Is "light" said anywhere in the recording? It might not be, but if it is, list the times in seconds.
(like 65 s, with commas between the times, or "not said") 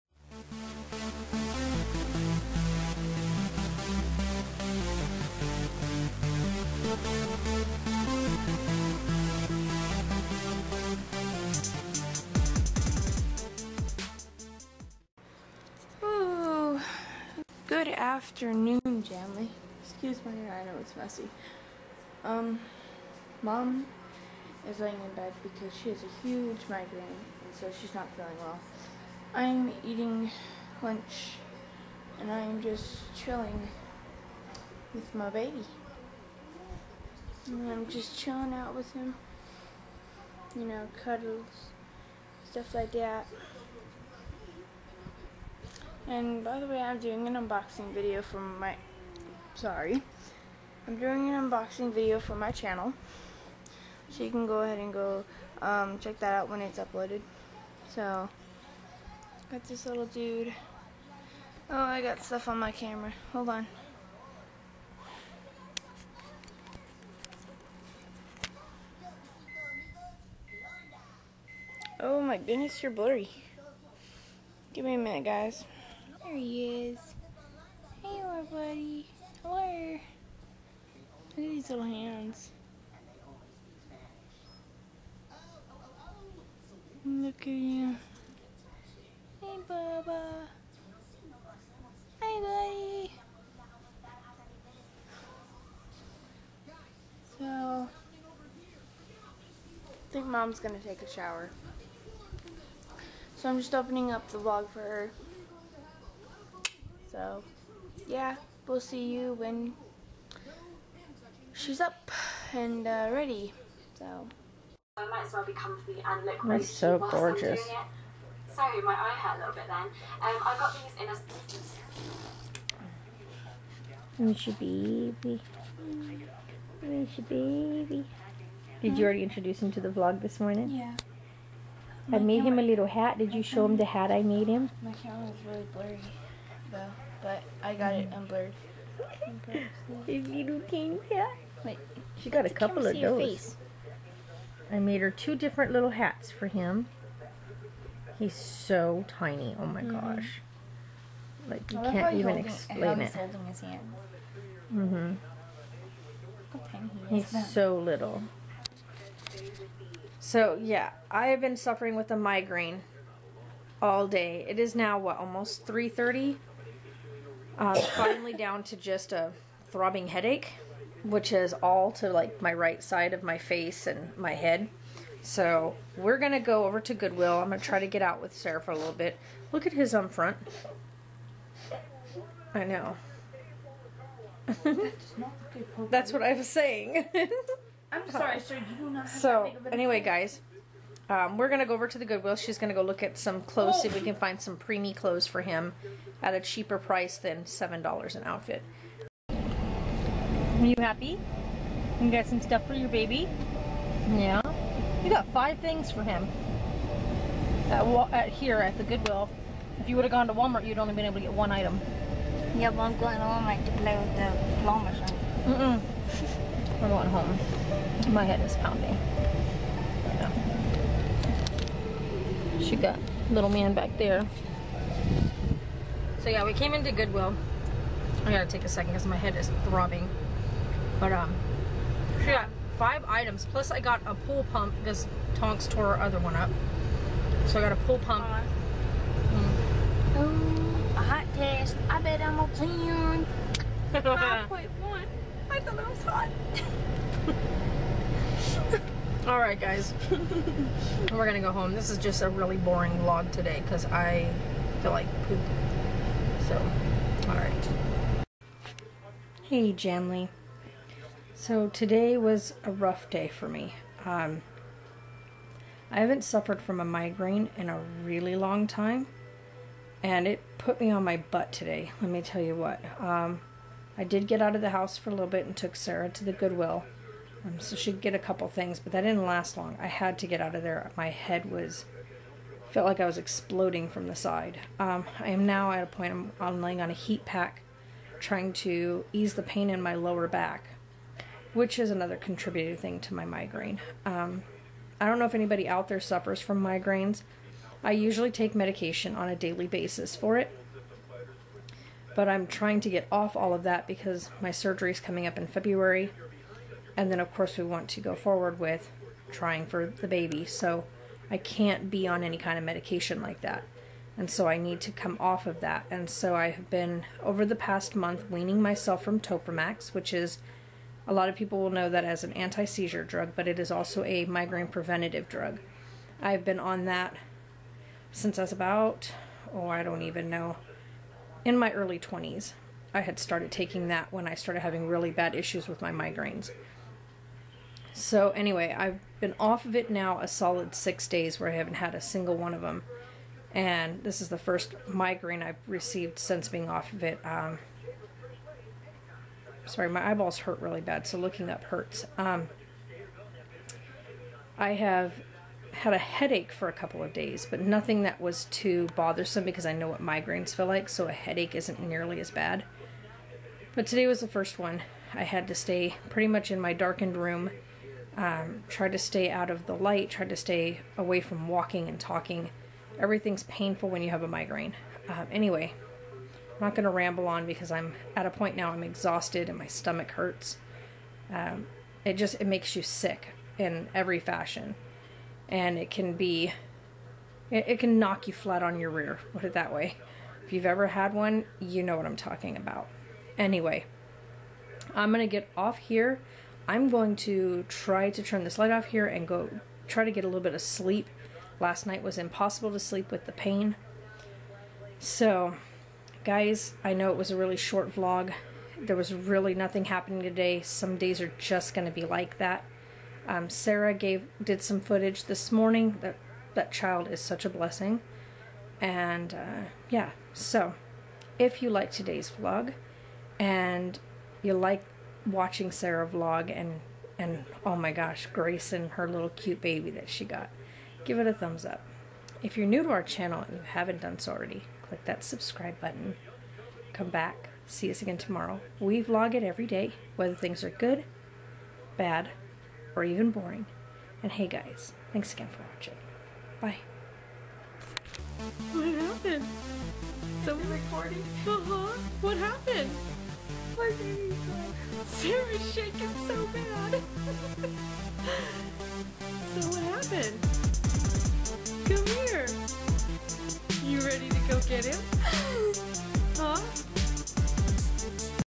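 369 s, 398 s.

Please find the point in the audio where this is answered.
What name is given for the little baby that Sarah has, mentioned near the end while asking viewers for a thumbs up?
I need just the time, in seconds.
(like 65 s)
428 s.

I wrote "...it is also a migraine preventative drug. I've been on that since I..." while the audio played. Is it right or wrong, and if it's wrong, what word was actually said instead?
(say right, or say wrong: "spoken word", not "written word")
right.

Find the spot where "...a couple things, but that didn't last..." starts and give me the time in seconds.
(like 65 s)
278 s.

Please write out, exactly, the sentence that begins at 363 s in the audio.
But today was the first one.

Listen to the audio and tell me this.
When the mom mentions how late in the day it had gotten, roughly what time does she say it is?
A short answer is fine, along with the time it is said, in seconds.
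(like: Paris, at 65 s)
3:30, at 165 s.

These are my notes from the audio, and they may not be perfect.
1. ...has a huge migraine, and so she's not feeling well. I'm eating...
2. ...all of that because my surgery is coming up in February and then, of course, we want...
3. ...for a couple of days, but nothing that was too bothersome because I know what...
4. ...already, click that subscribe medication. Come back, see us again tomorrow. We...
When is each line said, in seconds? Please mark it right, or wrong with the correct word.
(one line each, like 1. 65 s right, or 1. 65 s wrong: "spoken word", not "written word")
1. 25 s right
2. 303 s right
3. 356 s right
4. 434 s wrong: "button", not "medication".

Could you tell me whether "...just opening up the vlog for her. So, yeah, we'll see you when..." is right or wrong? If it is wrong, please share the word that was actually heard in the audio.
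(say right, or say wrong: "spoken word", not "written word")
right.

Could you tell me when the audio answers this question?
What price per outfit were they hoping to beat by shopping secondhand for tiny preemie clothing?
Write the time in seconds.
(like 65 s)
197 s.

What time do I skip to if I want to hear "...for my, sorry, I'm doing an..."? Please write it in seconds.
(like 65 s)
48 s.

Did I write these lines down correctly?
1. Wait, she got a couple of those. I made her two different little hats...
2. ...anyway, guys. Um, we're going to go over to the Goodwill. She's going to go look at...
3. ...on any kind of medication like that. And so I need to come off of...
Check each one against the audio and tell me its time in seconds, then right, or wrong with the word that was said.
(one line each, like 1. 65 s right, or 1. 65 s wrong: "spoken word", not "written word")
1. 141 s right
2. 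189 s right
3. 312 s right.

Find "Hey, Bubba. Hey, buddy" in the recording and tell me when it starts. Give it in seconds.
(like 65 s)
89 s.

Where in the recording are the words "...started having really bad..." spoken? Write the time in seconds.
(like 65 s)
334 s.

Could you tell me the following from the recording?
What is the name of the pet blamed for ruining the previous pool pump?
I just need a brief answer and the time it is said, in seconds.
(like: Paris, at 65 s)
Tonks, at 235 s.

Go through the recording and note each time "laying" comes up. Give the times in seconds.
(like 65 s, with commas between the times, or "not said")
24 s, 286 s.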